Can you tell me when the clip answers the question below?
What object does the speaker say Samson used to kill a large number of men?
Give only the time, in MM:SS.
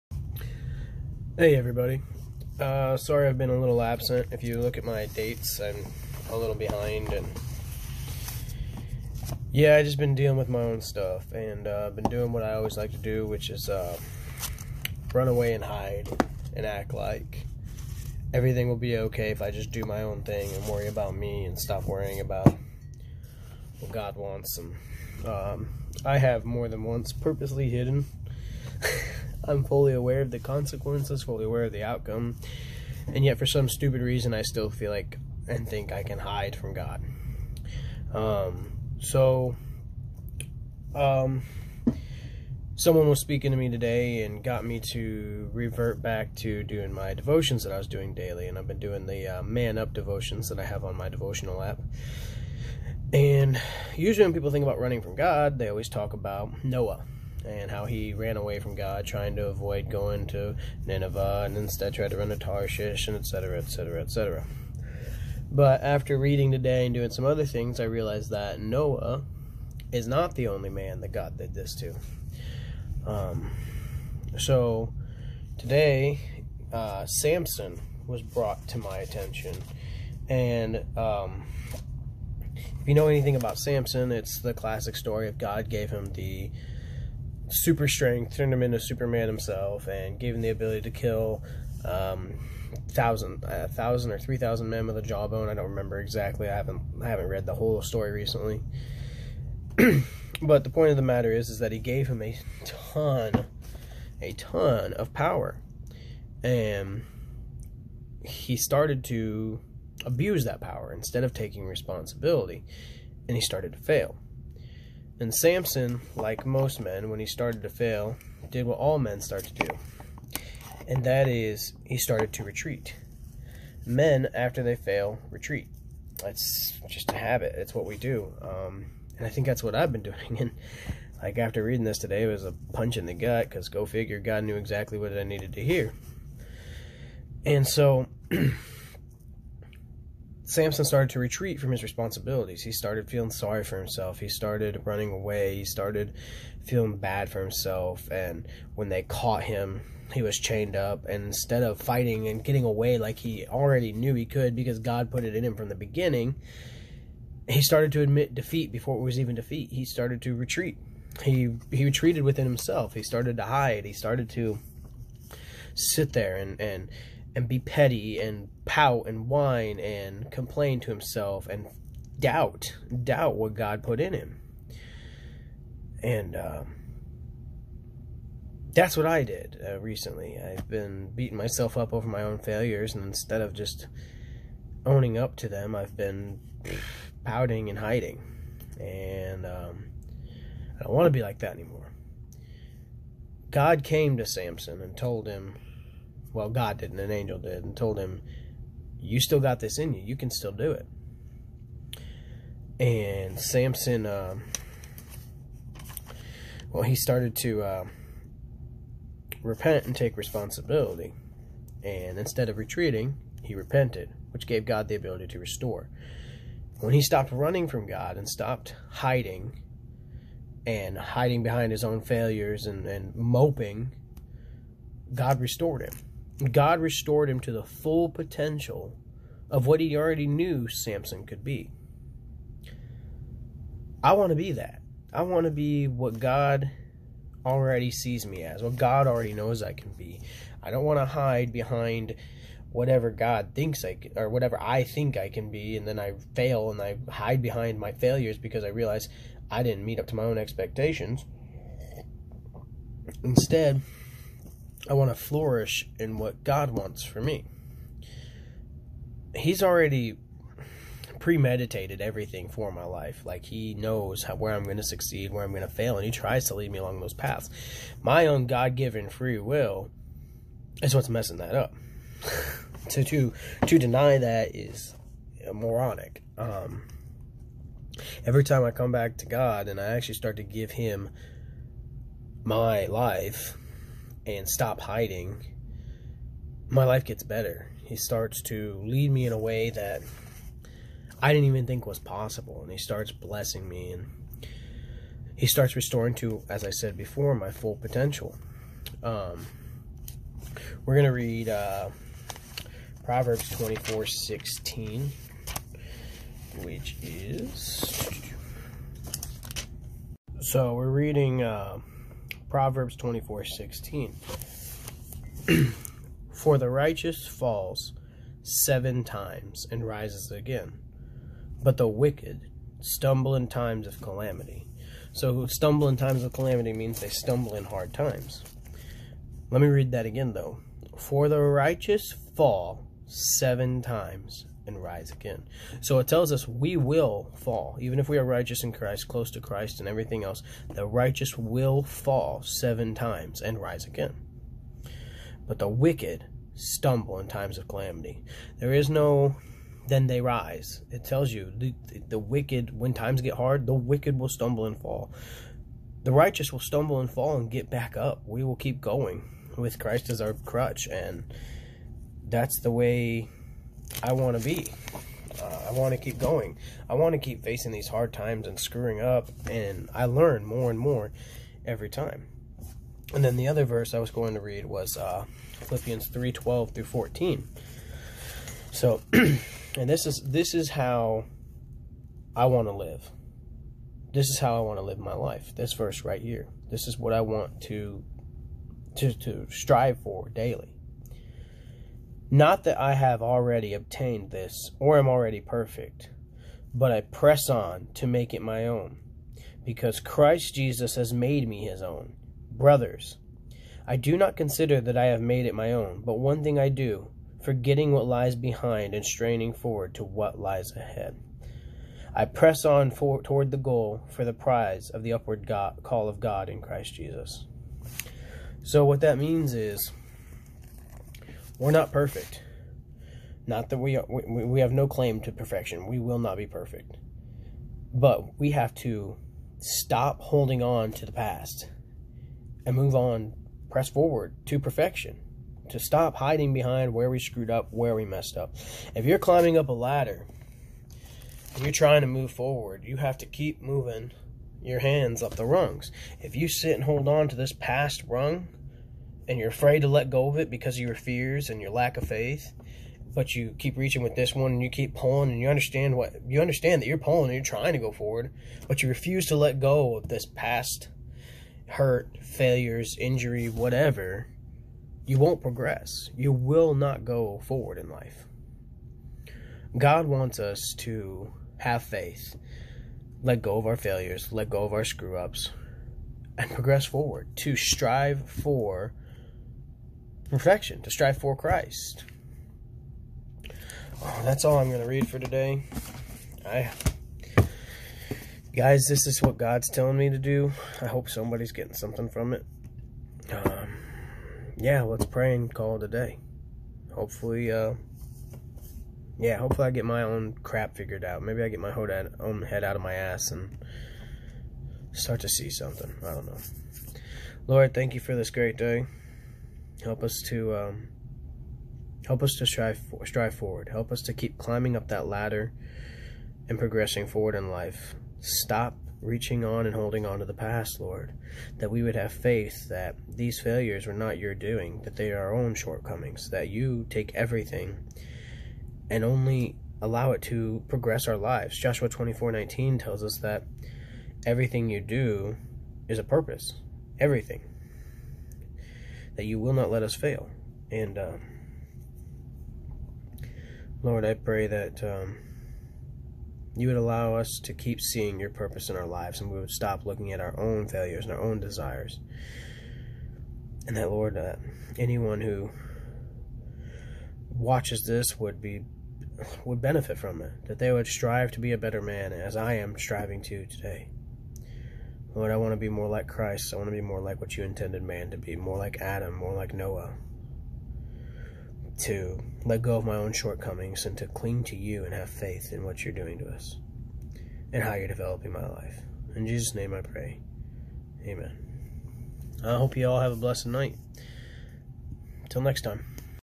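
01:35.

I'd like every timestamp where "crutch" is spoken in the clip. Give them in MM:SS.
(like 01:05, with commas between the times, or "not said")
06:00.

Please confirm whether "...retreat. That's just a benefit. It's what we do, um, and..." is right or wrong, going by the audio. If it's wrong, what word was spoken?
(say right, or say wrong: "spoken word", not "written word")
wrong: "habit", not "benefit".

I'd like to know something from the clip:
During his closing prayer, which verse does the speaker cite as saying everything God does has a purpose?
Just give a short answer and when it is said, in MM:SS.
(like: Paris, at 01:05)
Joshua 24:19, at 08:51.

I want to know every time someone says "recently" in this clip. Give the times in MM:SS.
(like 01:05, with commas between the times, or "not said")
01:38, 02:59.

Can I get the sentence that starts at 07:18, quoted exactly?
If you're climbing up a ladder and you're trying to move forward, you have to keep moving your hands up the rungs.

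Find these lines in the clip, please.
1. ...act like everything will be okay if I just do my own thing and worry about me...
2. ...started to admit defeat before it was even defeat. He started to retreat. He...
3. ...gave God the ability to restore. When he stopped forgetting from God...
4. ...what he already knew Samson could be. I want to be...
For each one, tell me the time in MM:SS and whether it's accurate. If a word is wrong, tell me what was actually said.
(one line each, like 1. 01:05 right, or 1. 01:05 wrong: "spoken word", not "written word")
1. 00:16 right
2. 02:37 right
3. 03:34 wrong: "running", not "forgetting"
4. 03:49 right.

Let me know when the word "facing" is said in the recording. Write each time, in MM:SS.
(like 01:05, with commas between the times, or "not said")
06:07.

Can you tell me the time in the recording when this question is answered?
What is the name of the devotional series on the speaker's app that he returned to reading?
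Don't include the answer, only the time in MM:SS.
00:49.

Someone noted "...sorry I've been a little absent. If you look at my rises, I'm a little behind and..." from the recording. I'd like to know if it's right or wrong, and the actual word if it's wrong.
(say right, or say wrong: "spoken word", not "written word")
wrong: "dates", not "rises".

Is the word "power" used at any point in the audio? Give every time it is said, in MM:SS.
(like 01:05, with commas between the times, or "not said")
01:45, 01:50.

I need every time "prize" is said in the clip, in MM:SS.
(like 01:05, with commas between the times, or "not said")
06:54.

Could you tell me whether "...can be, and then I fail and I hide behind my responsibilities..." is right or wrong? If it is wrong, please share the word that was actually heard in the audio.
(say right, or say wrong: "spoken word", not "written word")
wrong: "failures", not "responsibilities".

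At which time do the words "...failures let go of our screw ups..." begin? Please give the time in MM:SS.
07:53.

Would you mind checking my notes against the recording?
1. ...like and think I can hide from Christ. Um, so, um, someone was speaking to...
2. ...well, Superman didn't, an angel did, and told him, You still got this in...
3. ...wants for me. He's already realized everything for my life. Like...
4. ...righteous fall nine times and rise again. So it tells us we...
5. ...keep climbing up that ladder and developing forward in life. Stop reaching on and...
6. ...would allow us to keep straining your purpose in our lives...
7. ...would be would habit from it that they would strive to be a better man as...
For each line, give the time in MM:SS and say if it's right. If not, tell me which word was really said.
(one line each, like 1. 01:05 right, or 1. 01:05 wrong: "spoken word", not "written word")
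1. 00:34 wrong: "God", not "Christ"
2. 03:16 wrong: "God", not "Superman"
3. 04:16 wrong: "premeditated", not "realized"
4. 05:31 wrong: "seven", not "nine"
5. 08:34 wrong: "progressing", not "developing"
6. 09:06 wrong: "seeing", not "straining"
7. 09:18 wrong: "benefit", not "habit".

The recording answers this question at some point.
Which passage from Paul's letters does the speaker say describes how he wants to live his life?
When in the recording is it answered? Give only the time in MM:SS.
06:15.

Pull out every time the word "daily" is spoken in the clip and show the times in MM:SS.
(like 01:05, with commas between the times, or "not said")
00:48, 06:30.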